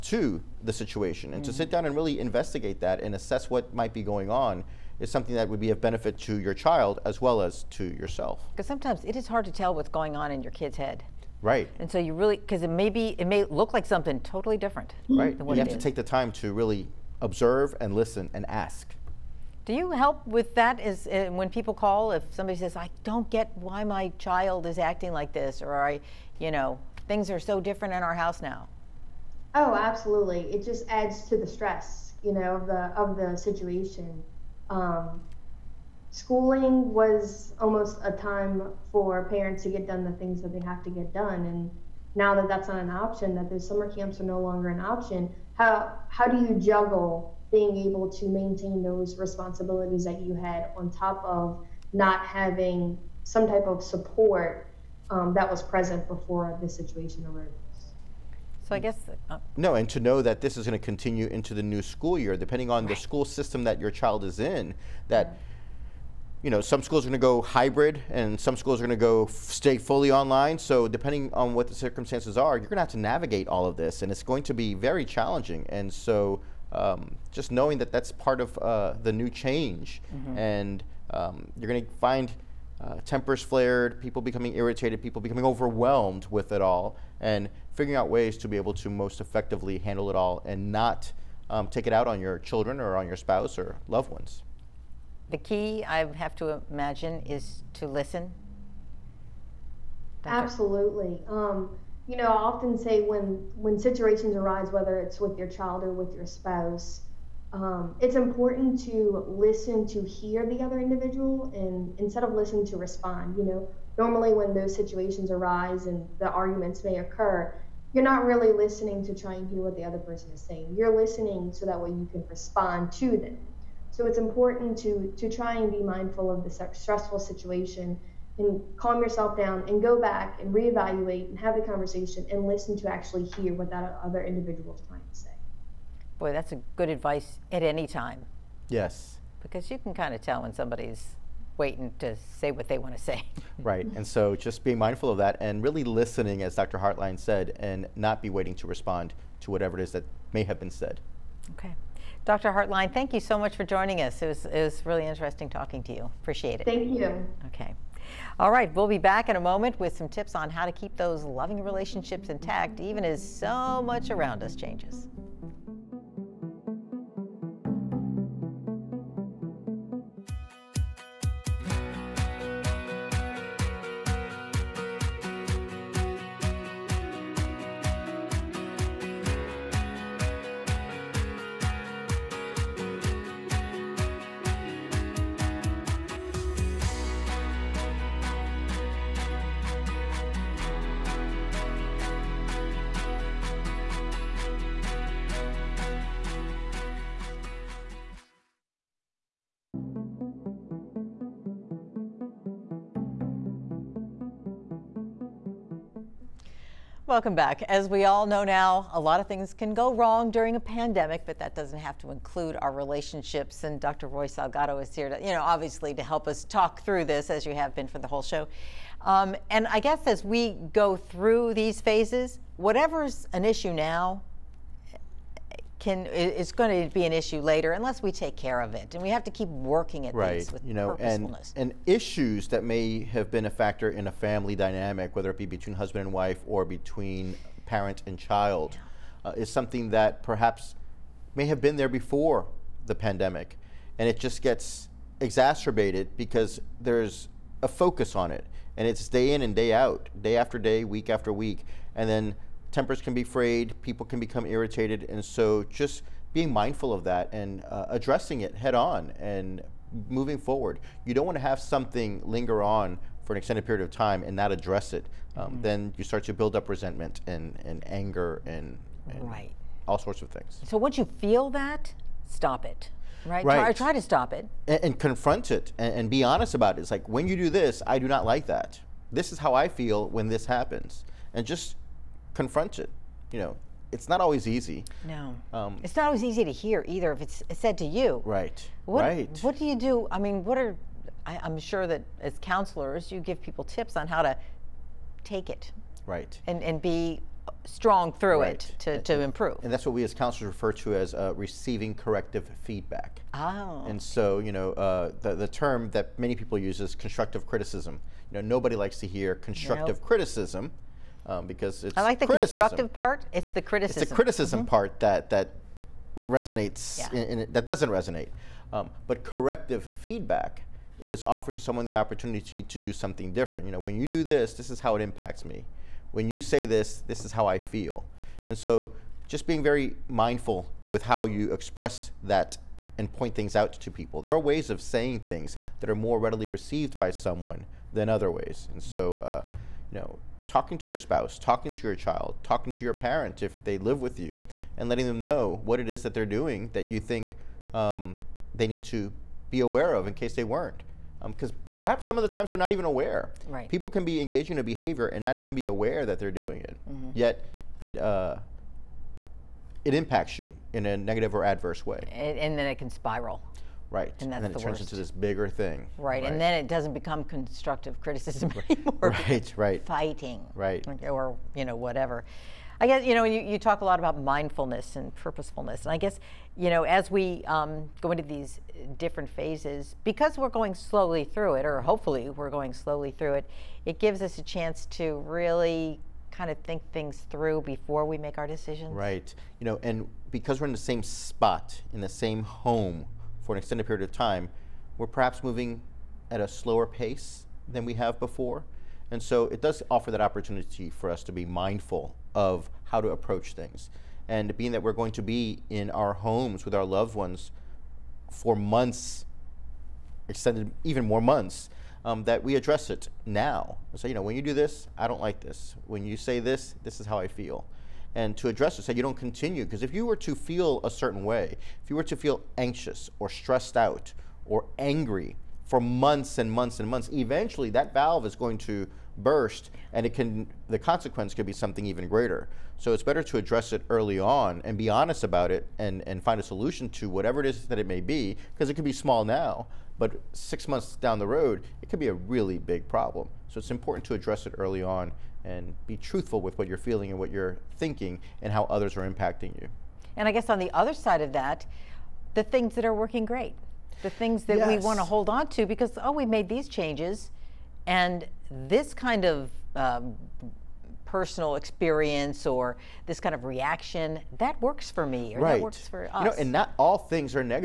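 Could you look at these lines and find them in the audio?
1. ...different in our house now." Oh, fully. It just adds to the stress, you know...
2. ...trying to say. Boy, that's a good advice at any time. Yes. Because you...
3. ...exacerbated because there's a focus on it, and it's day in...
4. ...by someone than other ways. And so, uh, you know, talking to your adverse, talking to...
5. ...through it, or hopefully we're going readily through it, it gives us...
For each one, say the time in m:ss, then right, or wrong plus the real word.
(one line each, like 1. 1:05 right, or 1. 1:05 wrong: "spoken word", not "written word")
1. 0:27 wrong: "absolutely", not "fully"
2. 2:14 right
3. 4:05 right
4. 5:36 wrong: "spouse", not "adverse"
5. 6:21 wrong: "slowly", not "readily".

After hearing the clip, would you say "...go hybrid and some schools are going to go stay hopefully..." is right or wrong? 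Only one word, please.
wrong.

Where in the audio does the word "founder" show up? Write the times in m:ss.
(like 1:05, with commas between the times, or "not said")
not said.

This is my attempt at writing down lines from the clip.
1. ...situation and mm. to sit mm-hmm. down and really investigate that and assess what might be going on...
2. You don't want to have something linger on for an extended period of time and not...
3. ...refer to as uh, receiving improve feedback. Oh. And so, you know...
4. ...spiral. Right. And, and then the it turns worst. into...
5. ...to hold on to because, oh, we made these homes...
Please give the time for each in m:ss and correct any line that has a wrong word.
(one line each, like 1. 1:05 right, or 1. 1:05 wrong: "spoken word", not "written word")
1. 0:00 right
2. 4:21 right
3. 5:00 wrong: "corrective", not "improve"
4. 6:02 right
5. 7:34 wrong: "changes", not "homes".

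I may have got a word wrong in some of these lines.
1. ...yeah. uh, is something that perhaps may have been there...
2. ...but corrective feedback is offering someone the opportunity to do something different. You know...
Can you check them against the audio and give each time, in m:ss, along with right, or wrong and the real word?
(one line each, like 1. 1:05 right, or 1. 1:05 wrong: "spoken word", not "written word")
1. 3:59 right
2. 5:19 right.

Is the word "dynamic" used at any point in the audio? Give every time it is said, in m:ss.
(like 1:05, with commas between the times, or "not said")
3:54.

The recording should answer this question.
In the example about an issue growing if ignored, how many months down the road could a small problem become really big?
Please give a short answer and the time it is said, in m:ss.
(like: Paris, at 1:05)
6, at 7:20.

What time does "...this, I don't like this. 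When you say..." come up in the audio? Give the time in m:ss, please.
6:54.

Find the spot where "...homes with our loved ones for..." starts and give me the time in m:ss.
6:46.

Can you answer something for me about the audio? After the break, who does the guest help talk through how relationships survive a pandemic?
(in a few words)
Dr. Roy Salgado.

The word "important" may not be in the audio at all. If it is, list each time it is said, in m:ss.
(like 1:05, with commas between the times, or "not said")
1:48, 2:04, 7:23.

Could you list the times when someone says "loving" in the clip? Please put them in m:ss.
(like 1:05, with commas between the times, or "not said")
2:41.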